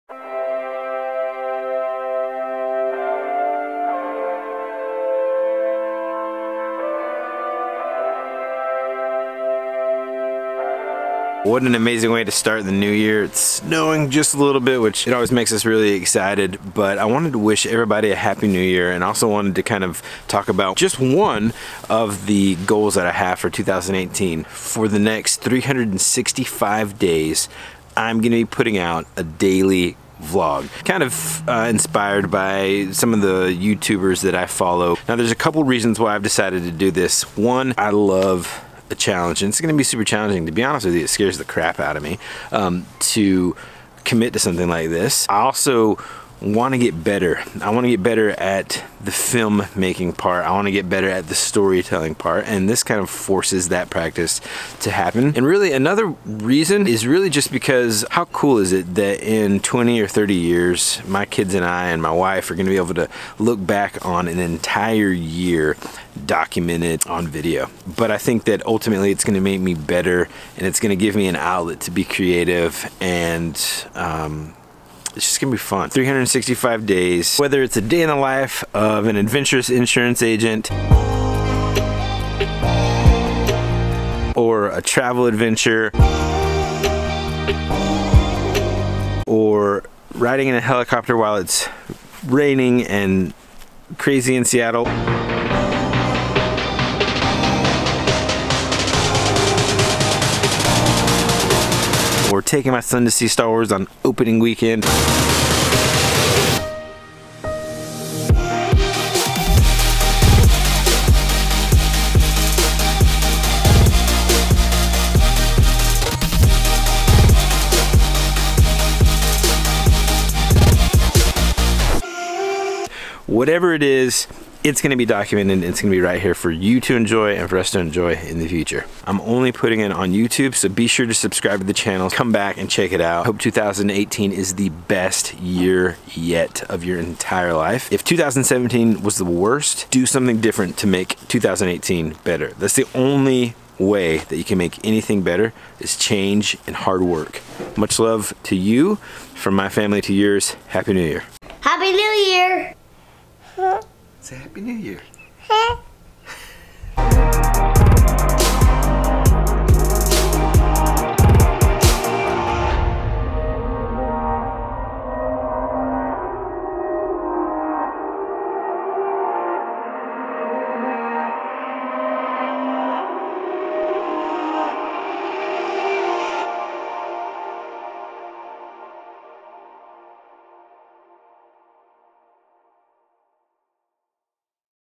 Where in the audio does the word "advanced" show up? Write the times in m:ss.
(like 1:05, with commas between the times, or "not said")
not said.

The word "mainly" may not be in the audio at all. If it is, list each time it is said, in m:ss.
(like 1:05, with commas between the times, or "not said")
not said.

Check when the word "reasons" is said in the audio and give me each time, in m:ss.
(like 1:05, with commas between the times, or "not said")
0:35, 0:56.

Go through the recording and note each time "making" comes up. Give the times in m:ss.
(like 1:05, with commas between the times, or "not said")
0:49.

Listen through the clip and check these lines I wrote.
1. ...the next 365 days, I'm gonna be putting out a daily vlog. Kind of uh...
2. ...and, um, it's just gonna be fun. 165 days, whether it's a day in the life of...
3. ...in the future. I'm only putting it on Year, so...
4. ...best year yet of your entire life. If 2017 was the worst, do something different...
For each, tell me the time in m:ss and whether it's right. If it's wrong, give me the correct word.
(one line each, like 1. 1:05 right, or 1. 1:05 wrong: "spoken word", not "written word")
1. 0:24 right
2. 1:12 wrong: "365", not "165"
3. 2:08 wrong: "YouTube", not "Year"
4. 2:14 right.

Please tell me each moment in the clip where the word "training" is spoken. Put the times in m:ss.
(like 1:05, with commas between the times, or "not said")
not said.